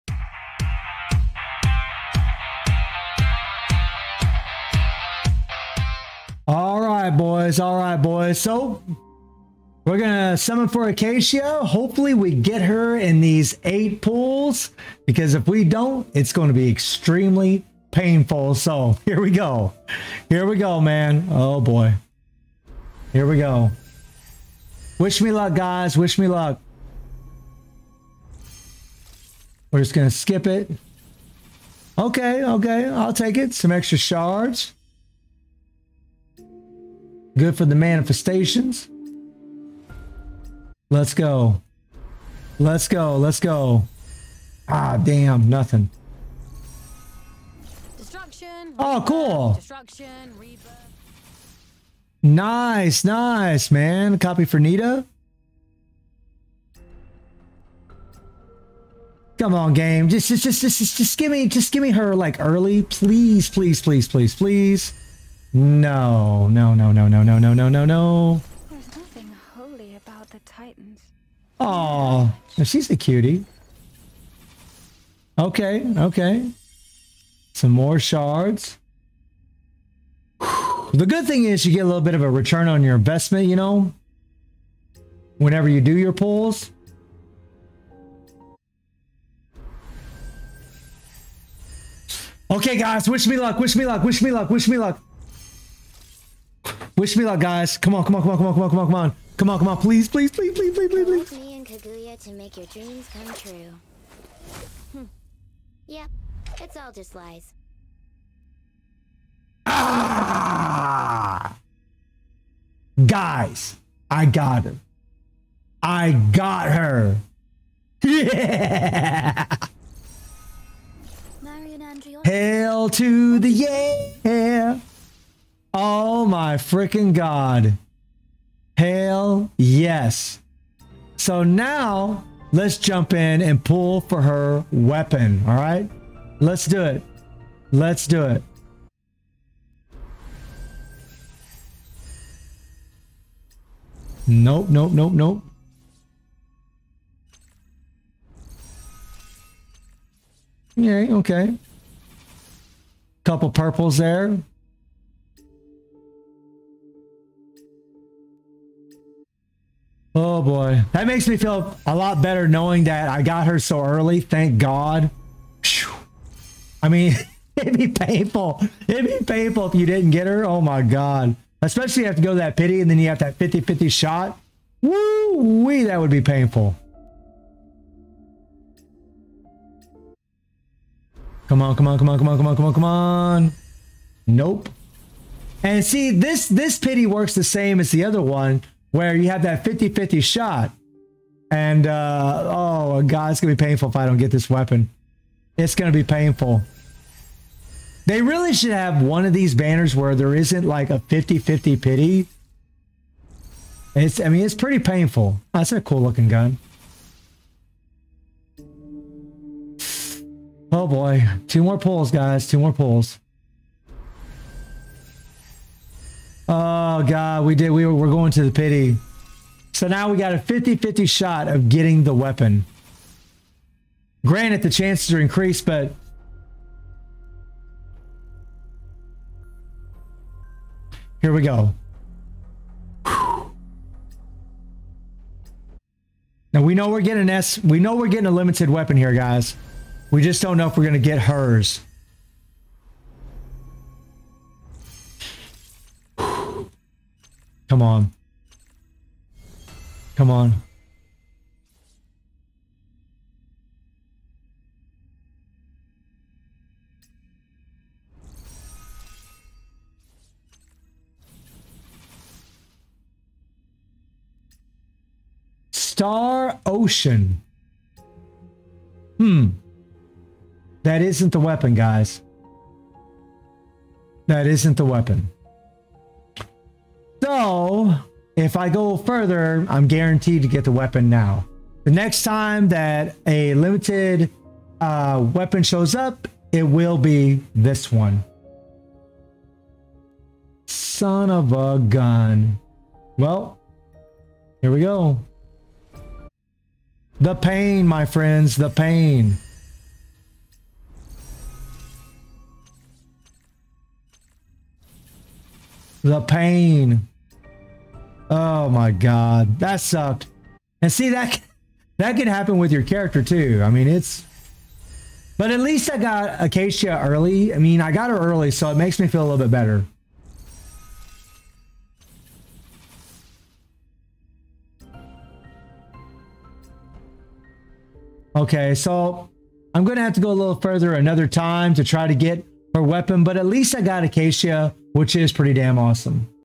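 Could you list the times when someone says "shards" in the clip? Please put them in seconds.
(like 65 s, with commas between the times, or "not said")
33 s, 77 s.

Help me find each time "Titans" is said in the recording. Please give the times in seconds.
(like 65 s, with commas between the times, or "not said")
70 s.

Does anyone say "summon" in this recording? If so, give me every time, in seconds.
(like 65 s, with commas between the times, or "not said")
10 s.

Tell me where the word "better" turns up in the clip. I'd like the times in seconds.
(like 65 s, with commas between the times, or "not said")
162 s, 319 s.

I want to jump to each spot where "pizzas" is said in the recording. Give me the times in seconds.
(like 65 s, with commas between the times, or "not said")
not said.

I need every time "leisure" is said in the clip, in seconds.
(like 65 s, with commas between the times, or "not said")
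not said.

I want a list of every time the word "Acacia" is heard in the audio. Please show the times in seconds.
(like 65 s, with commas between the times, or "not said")
10 s, 316 s, 334 s.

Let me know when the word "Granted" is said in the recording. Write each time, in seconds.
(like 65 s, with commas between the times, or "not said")
224 s.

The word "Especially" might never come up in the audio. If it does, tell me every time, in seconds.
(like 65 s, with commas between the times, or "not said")
171 s.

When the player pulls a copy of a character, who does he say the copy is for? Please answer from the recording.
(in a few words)
Nita.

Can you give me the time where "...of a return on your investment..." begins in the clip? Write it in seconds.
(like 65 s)
82 s.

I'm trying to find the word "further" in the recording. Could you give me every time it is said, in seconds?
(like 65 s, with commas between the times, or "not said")
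278 s, 330 s.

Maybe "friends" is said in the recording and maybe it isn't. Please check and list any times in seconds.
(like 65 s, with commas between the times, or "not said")
298 s.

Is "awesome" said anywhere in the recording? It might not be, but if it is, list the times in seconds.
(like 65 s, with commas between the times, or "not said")
335 s.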